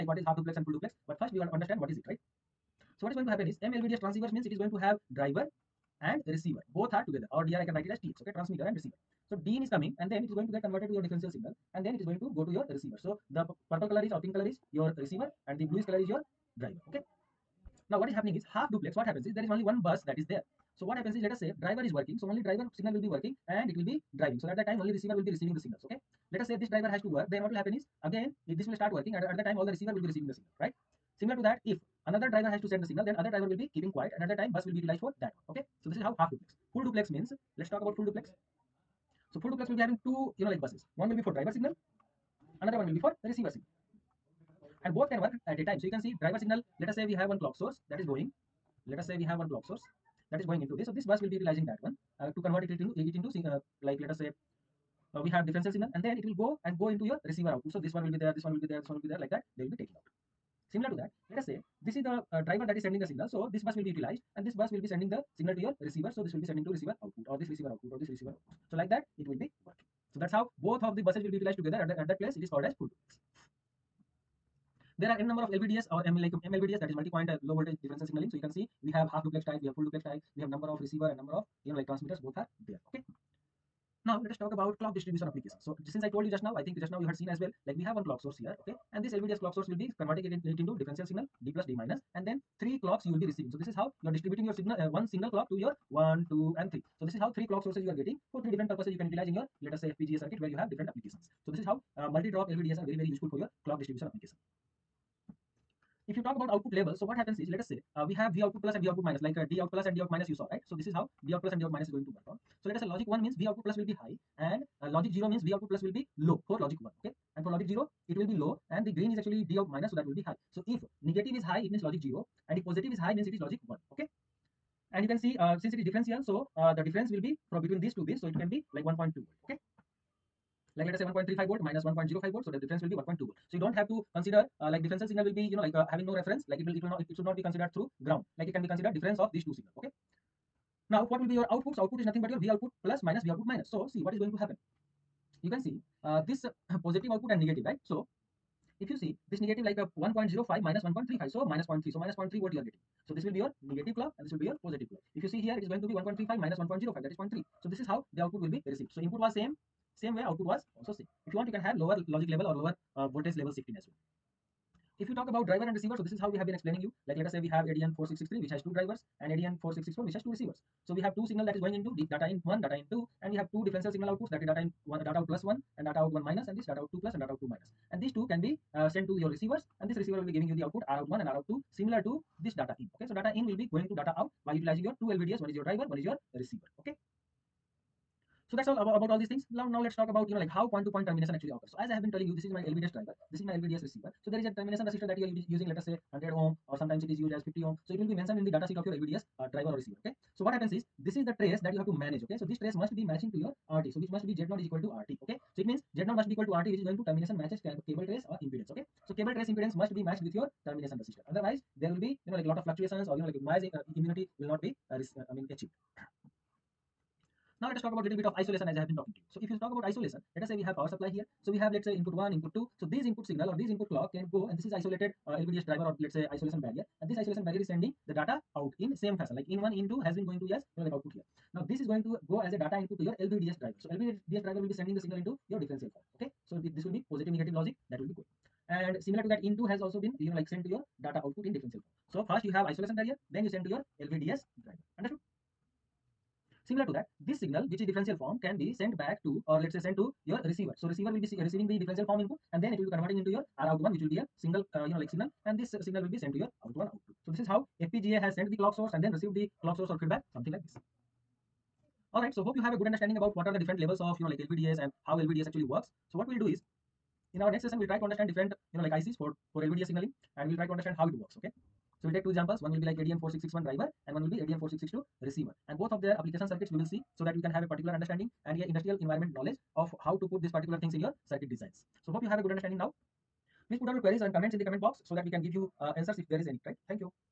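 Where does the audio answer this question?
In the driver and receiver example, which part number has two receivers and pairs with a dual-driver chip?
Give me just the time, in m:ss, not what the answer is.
2:49.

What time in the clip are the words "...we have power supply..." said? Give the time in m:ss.
3:40.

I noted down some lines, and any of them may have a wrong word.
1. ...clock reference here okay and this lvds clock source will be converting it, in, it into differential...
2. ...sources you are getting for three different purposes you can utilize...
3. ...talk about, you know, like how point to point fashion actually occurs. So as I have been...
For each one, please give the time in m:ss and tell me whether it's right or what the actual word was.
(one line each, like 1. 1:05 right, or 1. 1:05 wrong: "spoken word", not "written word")
1. 1:28 wrong: "source", not "reference"
2. 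1:37 right
3. 3:09 wrong: "termination", not "fashion".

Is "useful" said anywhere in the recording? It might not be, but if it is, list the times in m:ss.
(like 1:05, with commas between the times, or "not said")
1:43.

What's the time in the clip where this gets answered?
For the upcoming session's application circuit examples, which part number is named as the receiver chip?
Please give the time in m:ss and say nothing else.
4:34.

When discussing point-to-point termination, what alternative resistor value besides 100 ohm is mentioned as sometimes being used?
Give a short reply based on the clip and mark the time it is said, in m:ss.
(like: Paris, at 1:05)
50 ohm, at 3:17.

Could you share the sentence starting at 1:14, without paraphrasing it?
There are n number of LVDS or M like MLVDS that is multi-point uh, low voltage differential signaling.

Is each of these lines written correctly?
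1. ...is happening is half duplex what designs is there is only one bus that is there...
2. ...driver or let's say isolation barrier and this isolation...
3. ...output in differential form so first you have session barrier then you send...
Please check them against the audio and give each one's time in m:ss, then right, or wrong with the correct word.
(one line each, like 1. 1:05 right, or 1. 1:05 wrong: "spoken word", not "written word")
1. 0:18 wrong: "happens", not "designs"
2. 3:45 right
3. 4:01 wrong: "isolation", not "session".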